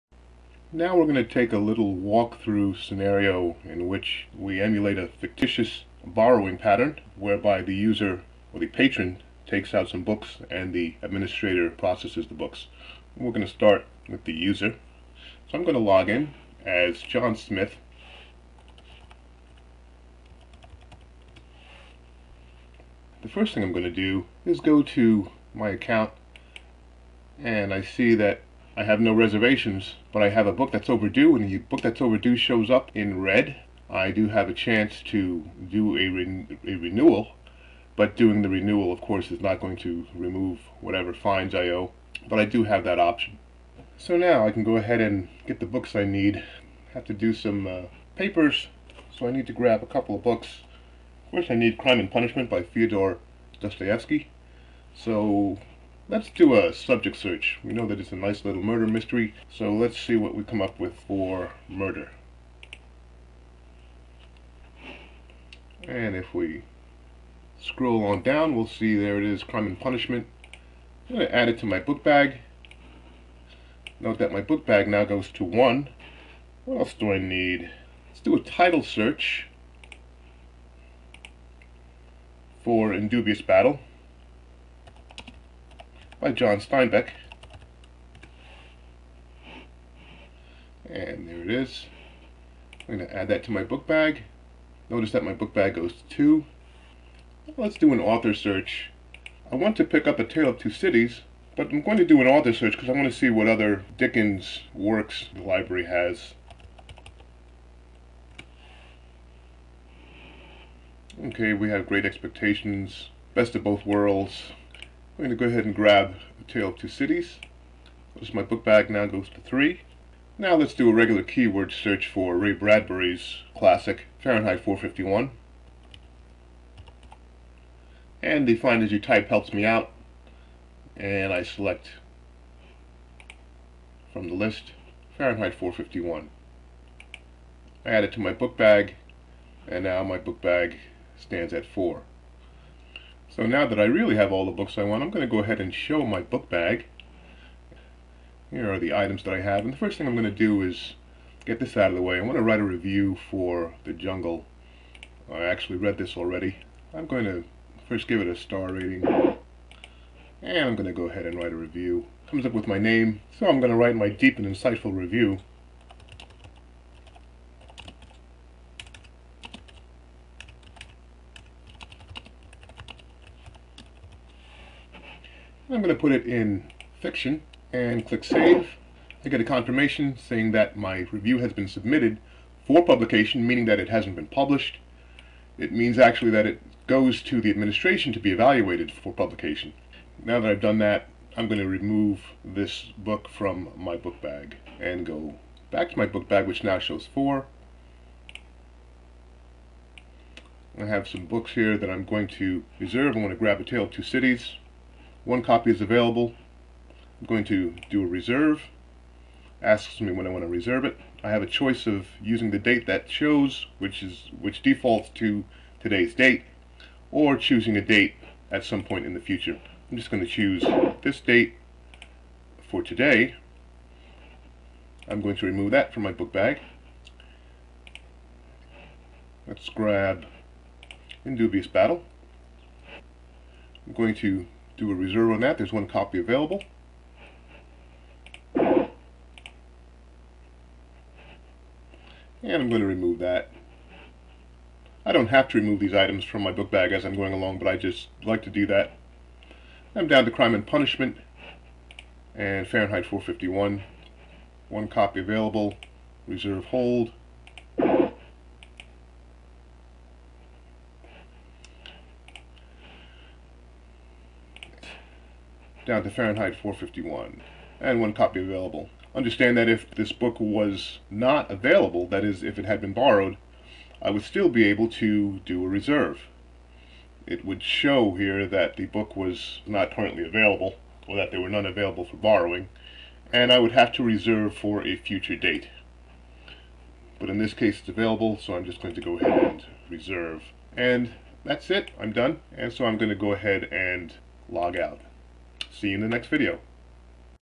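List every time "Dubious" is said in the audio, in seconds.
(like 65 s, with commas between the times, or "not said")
83 s, 231 s.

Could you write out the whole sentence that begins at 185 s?
It means actually that it goes to the administration to be evaluated for publication.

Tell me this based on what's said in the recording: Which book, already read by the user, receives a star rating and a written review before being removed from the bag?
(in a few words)
The Jungle.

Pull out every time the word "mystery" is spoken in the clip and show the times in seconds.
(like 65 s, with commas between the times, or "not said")
58 s.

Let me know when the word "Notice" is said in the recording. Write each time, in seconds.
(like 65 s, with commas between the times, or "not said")
94 s, 118 s.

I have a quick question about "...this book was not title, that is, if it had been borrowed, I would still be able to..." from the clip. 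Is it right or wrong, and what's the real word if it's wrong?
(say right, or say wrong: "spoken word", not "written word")
wrong: "available", not "title".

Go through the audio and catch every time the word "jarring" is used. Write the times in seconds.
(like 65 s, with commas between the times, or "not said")
not said.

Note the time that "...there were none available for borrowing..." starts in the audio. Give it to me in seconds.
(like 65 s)
281 s.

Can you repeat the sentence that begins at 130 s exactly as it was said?
And I select from the list Fahrenheit 451.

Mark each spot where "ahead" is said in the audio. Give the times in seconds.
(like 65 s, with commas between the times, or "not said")
44 s, 115 s, 145 s, 161 s, 289 s, 293 s.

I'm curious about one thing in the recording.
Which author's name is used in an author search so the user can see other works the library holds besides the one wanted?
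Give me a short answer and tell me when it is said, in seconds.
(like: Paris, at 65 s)
Dickens, at 103 s.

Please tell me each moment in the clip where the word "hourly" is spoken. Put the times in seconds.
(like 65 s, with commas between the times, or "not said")
not said.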